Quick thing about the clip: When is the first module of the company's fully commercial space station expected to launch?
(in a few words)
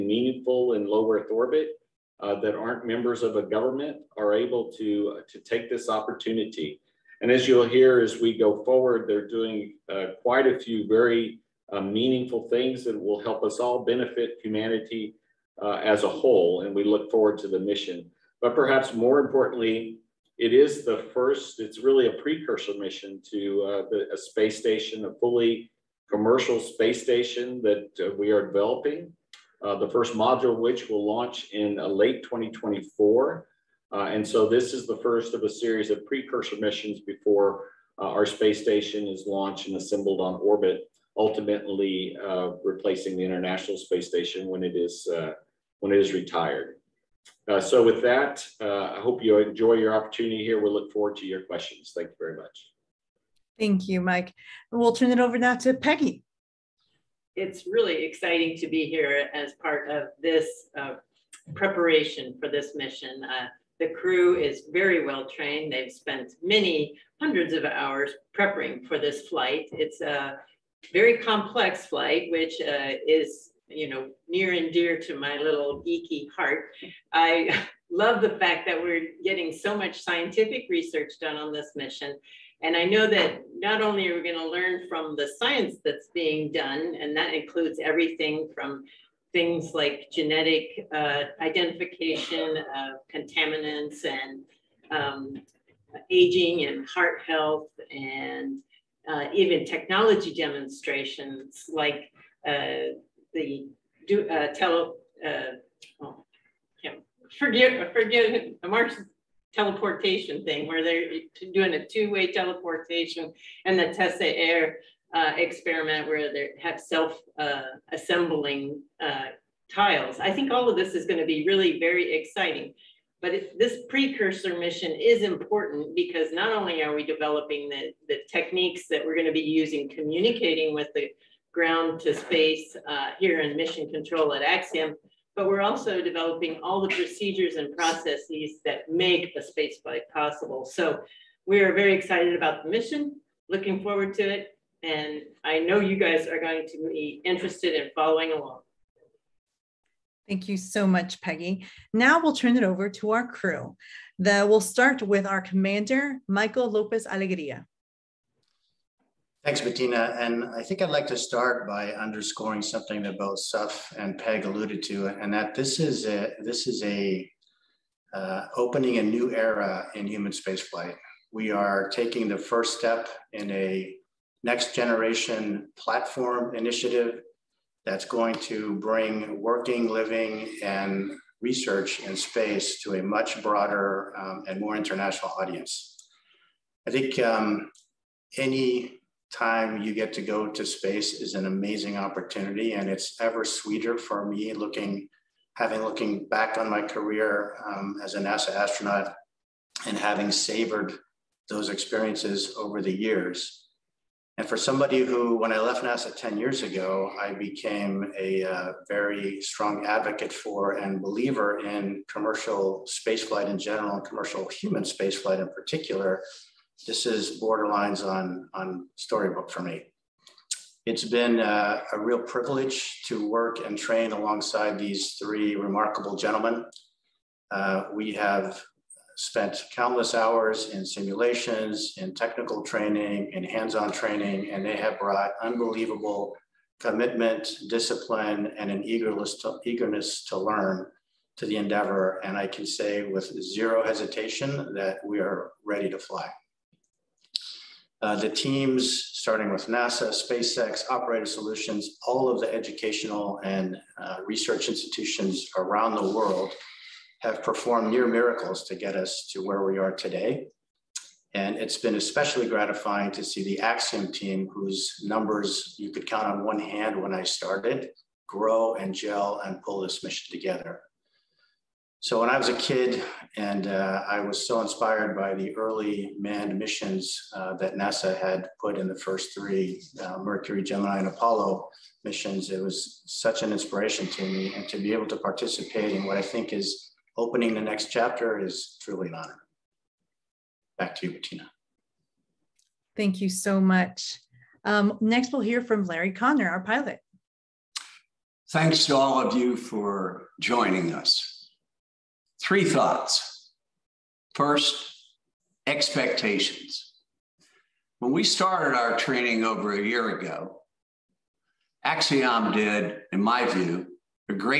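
late 2024.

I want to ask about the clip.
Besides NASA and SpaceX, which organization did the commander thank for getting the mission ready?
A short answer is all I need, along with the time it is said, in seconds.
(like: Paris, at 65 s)
Operator Solutions, at 250 s.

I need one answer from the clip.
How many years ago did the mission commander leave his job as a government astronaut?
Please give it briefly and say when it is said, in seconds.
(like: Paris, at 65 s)
10, at 206 s.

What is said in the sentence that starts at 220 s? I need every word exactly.
It's been a, a real privilege to work and train alongside these three remarkable gentlemen.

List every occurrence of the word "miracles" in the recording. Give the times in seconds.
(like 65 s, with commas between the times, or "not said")
258 s.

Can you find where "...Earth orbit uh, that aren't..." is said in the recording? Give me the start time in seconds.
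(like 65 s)
1 s.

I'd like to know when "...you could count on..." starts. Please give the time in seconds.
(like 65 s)
265 s.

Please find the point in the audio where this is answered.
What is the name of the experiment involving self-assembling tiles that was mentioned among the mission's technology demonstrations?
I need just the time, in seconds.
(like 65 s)
113 s.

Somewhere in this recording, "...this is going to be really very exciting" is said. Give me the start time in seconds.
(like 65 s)
120 s.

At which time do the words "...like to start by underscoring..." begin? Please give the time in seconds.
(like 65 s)
160 s.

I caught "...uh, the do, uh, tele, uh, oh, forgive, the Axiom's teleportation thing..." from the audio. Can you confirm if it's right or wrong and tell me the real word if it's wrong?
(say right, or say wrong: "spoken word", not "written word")
wrong: "Mark", not "Axiom".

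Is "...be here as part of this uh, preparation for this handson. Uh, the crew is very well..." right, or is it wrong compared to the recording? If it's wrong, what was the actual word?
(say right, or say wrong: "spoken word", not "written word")
wrong: "mission", not "handson".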